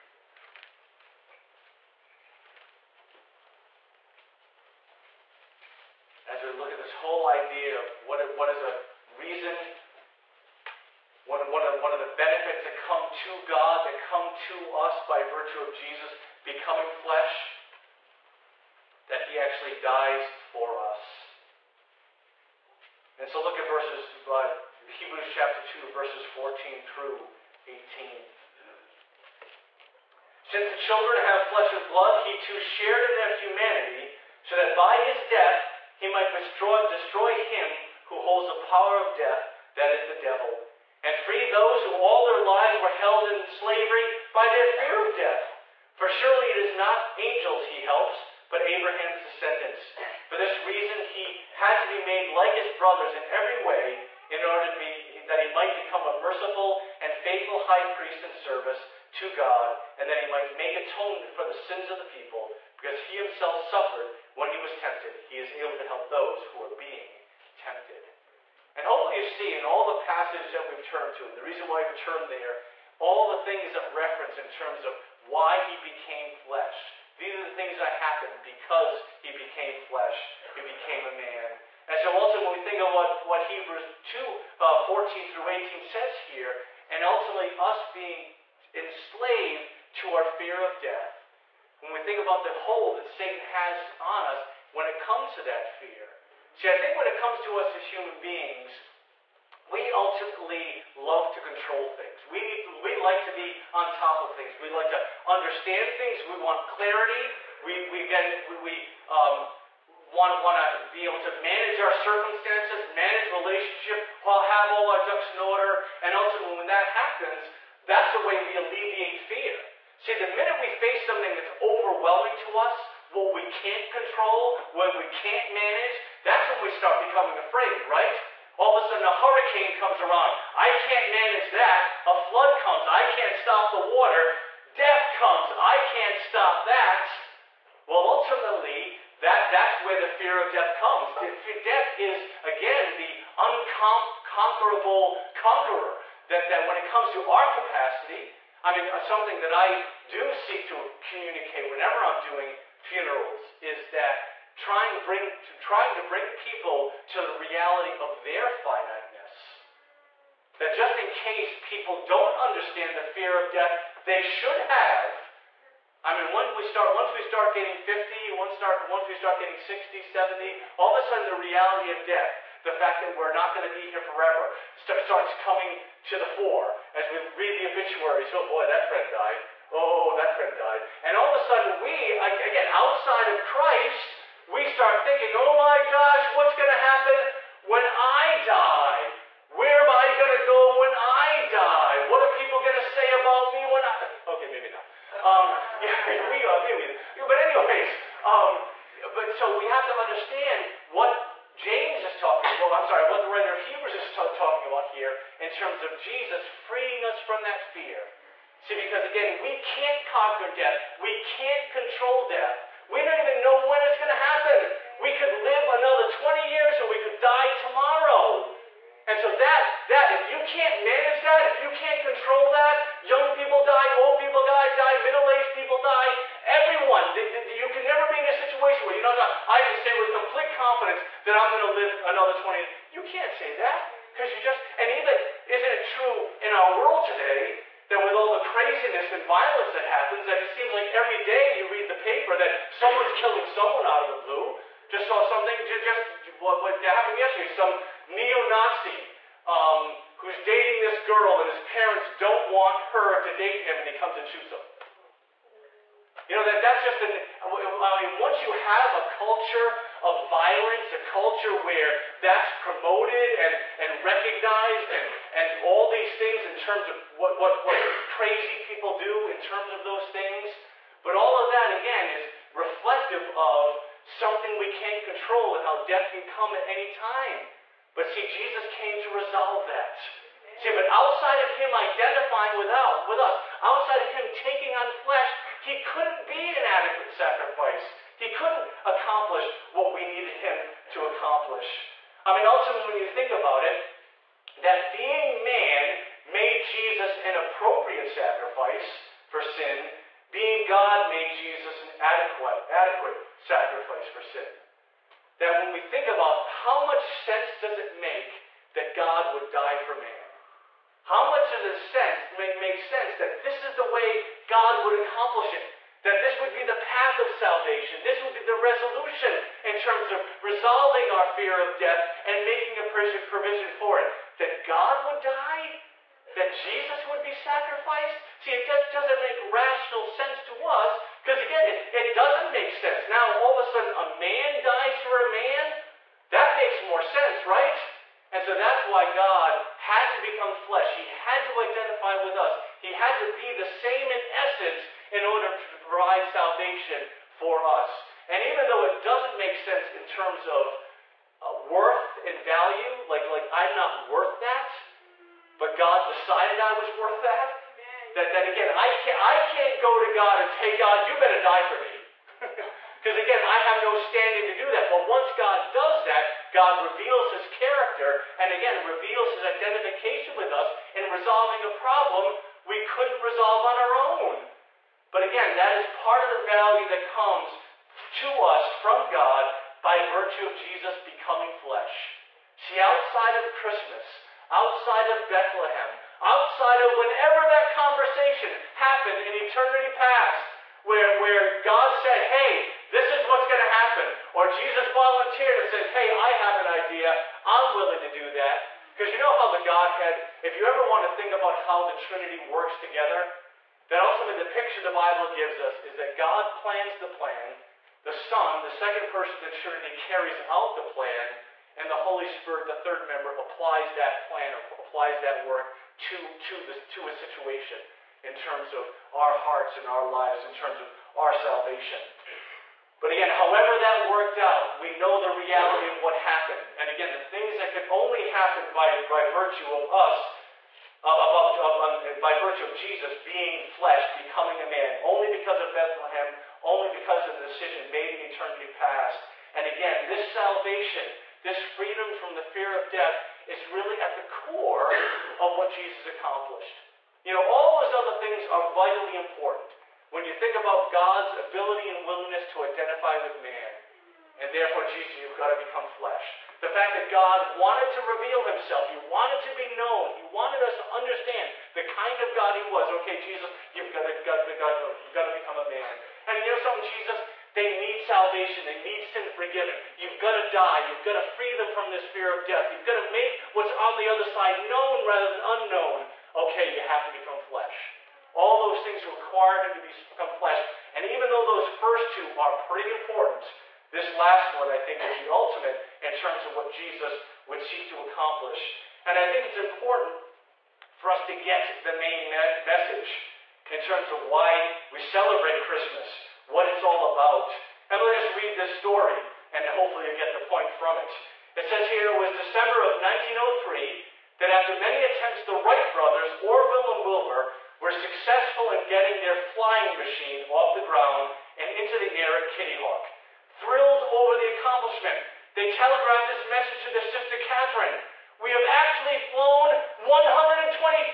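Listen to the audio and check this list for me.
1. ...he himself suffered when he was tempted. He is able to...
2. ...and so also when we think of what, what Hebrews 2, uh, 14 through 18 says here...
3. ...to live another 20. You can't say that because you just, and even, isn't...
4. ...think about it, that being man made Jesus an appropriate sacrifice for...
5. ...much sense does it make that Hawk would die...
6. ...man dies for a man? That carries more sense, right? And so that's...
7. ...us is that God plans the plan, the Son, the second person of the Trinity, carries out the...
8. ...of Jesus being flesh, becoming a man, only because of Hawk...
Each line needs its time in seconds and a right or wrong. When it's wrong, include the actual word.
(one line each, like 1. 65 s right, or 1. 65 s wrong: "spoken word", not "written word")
1. 63 s right
2. 81 s right
3. 231 s right
4. 293 s right
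5. 306 s wrong: "God", not "Hawk"
6. 334 s wrong: "makes", not "carries"
7. 405 s right
8. 432 s wrong: "Bethlehem", not "Hawk".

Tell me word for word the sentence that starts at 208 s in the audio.
See, because again, we can't conquer death.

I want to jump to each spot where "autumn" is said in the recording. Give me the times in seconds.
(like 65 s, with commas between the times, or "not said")
not said.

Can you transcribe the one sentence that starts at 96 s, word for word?
See, I think when it comes to us as human beings, we ultimately love to control things.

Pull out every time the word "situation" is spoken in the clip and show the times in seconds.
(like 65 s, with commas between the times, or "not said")
228 s, 417 s.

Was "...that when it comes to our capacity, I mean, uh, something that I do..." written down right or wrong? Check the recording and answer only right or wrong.
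right.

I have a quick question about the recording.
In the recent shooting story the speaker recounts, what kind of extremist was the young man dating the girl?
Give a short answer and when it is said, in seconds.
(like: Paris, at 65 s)
neo-Nazi, at 248 s.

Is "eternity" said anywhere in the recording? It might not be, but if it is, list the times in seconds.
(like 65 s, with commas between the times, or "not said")
389 s, 438 s.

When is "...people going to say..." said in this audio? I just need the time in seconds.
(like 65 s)
192 s.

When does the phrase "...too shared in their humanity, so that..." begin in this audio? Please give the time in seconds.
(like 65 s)
32 s.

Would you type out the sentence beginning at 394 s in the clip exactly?
Or Jesus volunteered and said, hey, I have an idea.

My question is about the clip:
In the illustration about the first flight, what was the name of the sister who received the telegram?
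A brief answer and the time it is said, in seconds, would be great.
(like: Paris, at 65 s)
Catherine, at 517 s.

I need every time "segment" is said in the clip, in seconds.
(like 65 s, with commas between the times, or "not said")
not said.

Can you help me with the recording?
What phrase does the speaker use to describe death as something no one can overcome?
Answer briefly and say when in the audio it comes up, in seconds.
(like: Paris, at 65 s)
the unconquerable conqueror, at 142 s.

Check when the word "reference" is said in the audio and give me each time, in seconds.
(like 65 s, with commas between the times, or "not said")
73 s.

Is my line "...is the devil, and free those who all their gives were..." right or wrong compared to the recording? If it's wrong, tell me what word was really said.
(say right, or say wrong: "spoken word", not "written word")
wrong: "lives", not "gives".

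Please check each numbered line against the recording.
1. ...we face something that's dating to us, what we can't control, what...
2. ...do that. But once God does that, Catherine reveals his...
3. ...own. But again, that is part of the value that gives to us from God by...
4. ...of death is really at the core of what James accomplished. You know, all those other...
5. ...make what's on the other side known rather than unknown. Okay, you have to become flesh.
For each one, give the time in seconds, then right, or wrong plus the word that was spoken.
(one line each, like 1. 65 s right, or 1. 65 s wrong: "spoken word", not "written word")
1. 120 s wrong: "overwhelming", not "dating"
2. 364 s wrong: "God", not "Catherine"
3. 373 s wrong: "comes", not "gives"
4. 442 s wrong: "Jesus", not "James"
5. 473 s right.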